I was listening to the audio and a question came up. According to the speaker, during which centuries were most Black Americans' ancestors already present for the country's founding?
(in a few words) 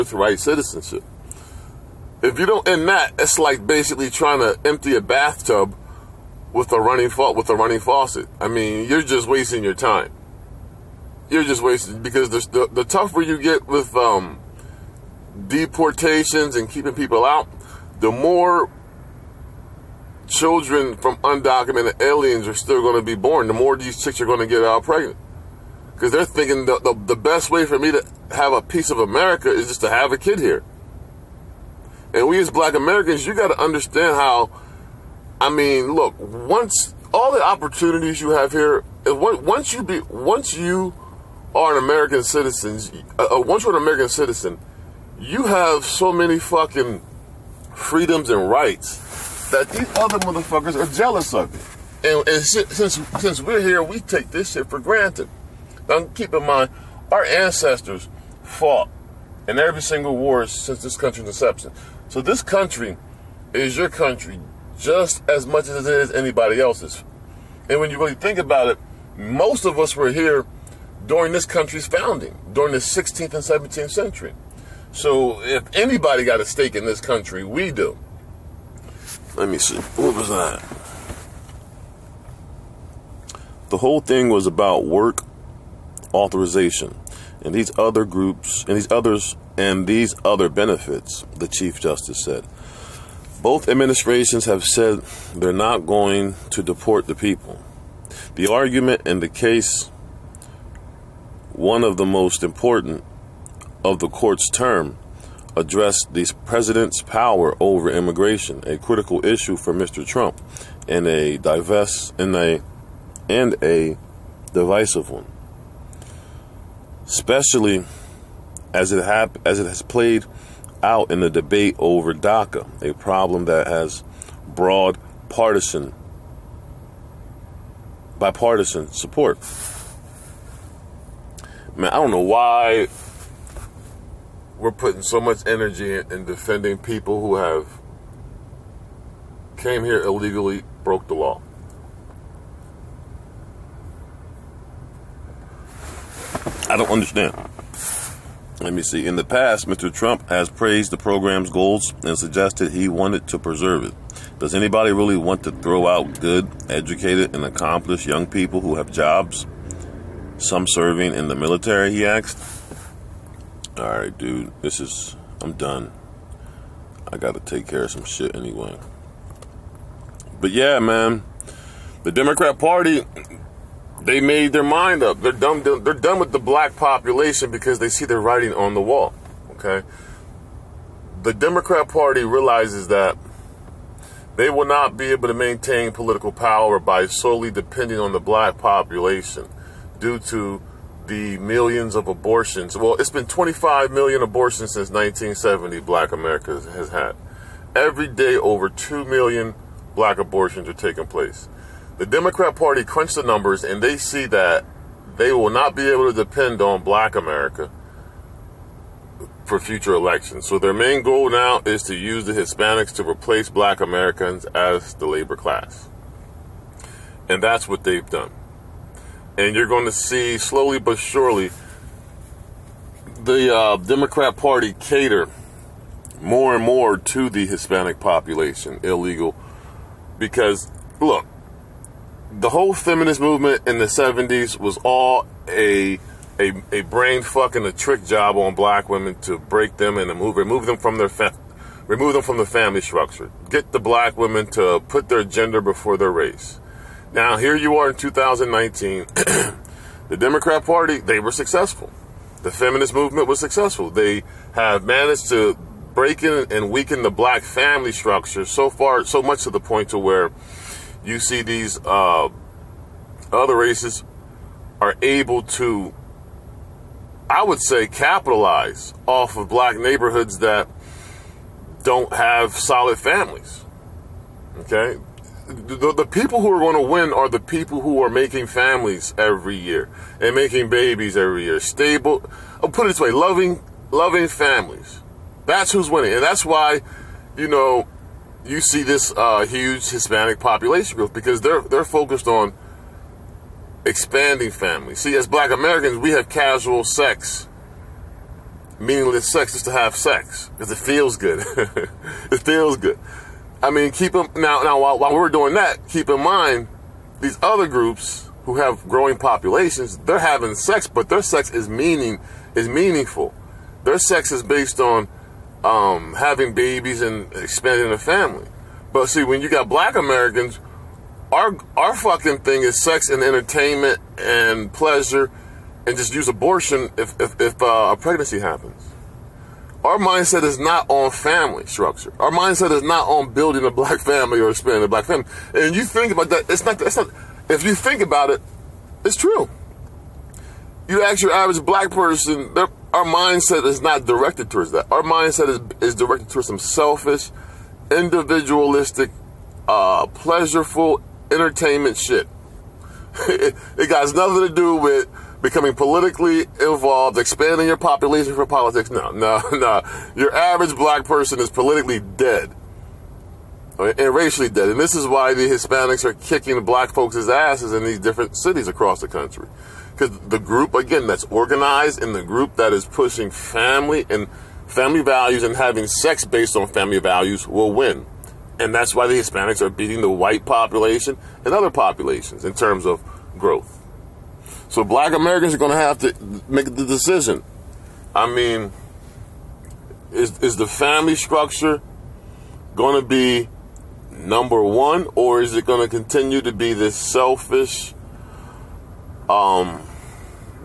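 16th and 17th century.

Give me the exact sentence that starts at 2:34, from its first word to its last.
Does anybody really want to throw out good, educated, and accomplished young people who have jobs?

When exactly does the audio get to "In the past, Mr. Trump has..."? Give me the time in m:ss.
2:29.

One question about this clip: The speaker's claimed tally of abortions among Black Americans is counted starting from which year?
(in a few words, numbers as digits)
1970.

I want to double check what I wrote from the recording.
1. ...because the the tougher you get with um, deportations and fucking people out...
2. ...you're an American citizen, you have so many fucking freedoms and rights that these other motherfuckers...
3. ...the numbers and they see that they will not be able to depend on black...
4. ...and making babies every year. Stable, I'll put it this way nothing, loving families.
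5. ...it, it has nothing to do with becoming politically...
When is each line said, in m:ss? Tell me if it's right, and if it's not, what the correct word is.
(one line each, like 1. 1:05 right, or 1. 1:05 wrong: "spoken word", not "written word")
1. 0:12 wrong: "keeping", not "fucking"
2. 0:43 right
3. 3:23 right
4. 4:40 wrong: "loving", not "nothing"
5. 5:53 right.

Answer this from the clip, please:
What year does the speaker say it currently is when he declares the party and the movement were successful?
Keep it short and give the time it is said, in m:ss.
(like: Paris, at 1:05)
2019, at 4:07.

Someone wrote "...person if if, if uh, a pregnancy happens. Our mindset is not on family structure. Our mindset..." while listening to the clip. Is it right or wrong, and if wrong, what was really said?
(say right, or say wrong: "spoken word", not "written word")
wrong: "abortion", not "person".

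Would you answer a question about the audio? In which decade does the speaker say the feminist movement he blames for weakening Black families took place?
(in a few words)
the 70s.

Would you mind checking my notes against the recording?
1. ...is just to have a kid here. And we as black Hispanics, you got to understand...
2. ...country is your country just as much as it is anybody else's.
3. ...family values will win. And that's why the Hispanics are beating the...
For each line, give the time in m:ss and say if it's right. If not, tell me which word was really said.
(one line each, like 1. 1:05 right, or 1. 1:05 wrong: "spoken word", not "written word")
1. 0:29 wrong: "Americans", not "Hispanics"
2. 1:02 right
3. 6:16 right.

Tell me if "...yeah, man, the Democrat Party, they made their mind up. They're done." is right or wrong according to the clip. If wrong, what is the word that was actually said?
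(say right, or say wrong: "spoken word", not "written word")
right.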